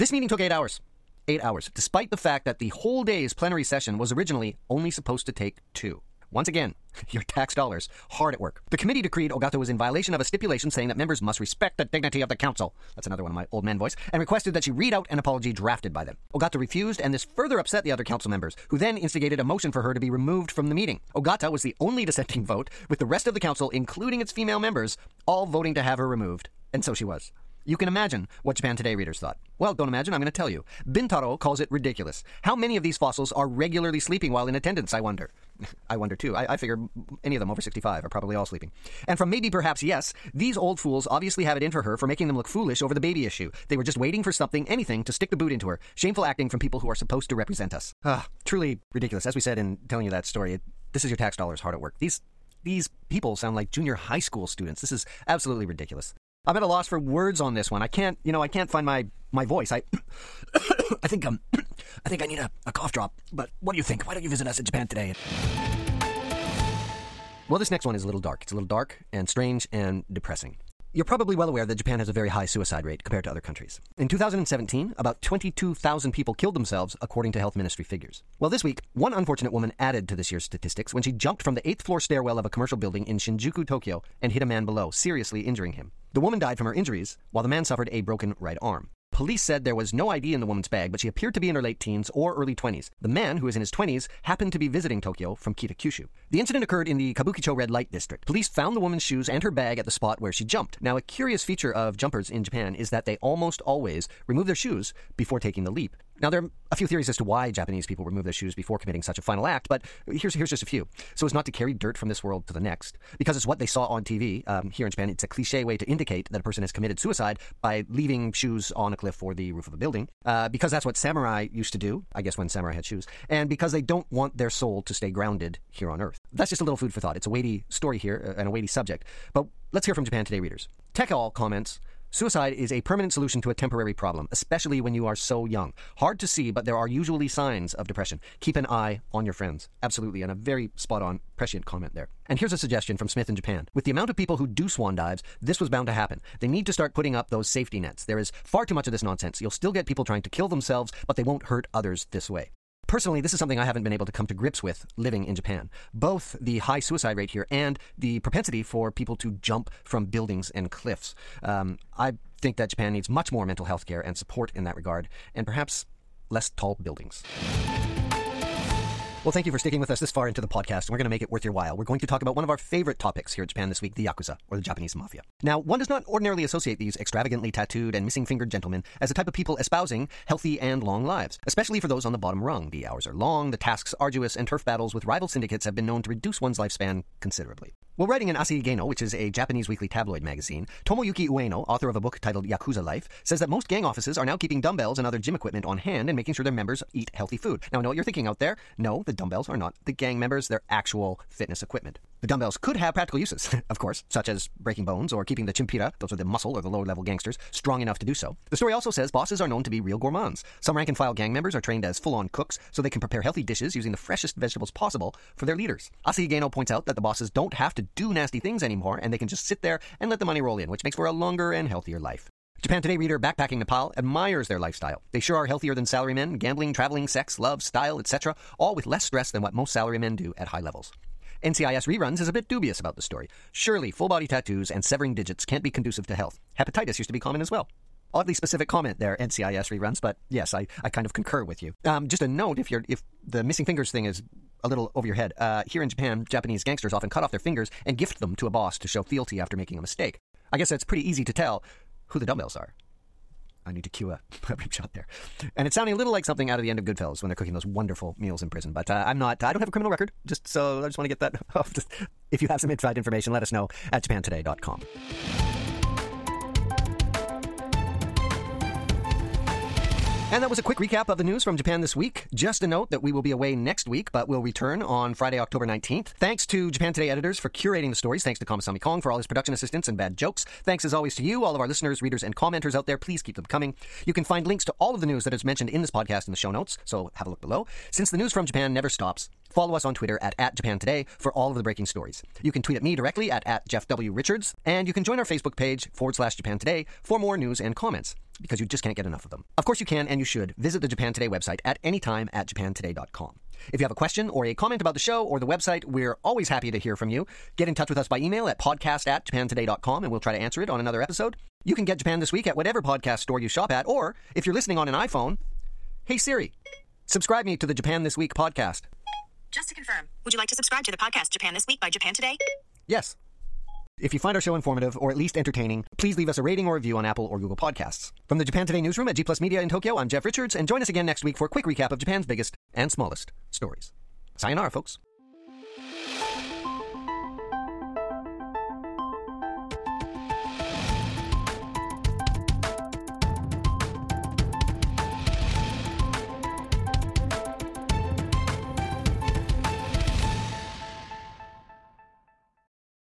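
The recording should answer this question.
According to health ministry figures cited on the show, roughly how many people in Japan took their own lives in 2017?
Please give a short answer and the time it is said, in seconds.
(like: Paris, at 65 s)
22,000, at 75 s.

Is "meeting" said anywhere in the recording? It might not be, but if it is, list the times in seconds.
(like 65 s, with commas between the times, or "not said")
0 s, 20 s.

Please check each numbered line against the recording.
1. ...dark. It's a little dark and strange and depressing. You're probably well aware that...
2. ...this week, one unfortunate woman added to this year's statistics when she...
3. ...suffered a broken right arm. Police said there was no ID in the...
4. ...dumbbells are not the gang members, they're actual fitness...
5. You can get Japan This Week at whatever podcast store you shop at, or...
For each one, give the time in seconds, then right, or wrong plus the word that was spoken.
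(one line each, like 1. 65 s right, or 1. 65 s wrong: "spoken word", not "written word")
1. 68 s right
2. 78 s right
3. 87 s right
4. 199 s right
5. 311 s right.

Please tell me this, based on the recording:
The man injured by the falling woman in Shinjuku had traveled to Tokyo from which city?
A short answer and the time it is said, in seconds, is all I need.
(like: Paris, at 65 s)
Kita Kyushu, at 95 s.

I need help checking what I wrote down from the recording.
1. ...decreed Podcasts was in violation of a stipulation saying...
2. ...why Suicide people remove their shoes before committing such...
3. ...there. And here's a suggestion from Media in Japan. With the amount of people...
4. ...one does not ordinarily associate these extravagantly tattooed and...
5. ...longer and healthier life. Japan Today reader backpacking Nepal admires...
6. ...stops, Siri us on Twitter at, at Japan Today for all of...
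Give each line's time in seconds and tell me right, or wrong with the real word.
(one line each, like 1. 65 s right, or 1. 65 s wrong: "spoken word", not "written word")
1. 9 s wrong: "Ogata", not "Podcasts"
2. 107 s wrong: "Japanese", not "Suicide"
3. 141 s wrong: "Smith", not "Media"
4. 175 s right
5. 221 s right
6. 288 s wrong: "Follow", not "Siri".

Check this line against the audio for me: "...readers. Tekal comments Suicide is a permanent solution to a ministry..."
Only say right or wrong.
wrong.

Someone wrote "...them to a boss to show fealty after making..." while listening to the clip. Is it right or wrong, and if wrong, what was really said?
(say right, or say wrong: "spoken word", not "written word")
right.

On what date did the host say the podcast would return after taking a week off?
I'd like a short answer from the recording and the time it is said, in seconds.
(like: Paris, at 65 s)
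October 19th, at 275 s.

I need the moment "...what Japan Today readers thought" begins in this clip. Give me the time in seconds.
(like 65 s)
28 s.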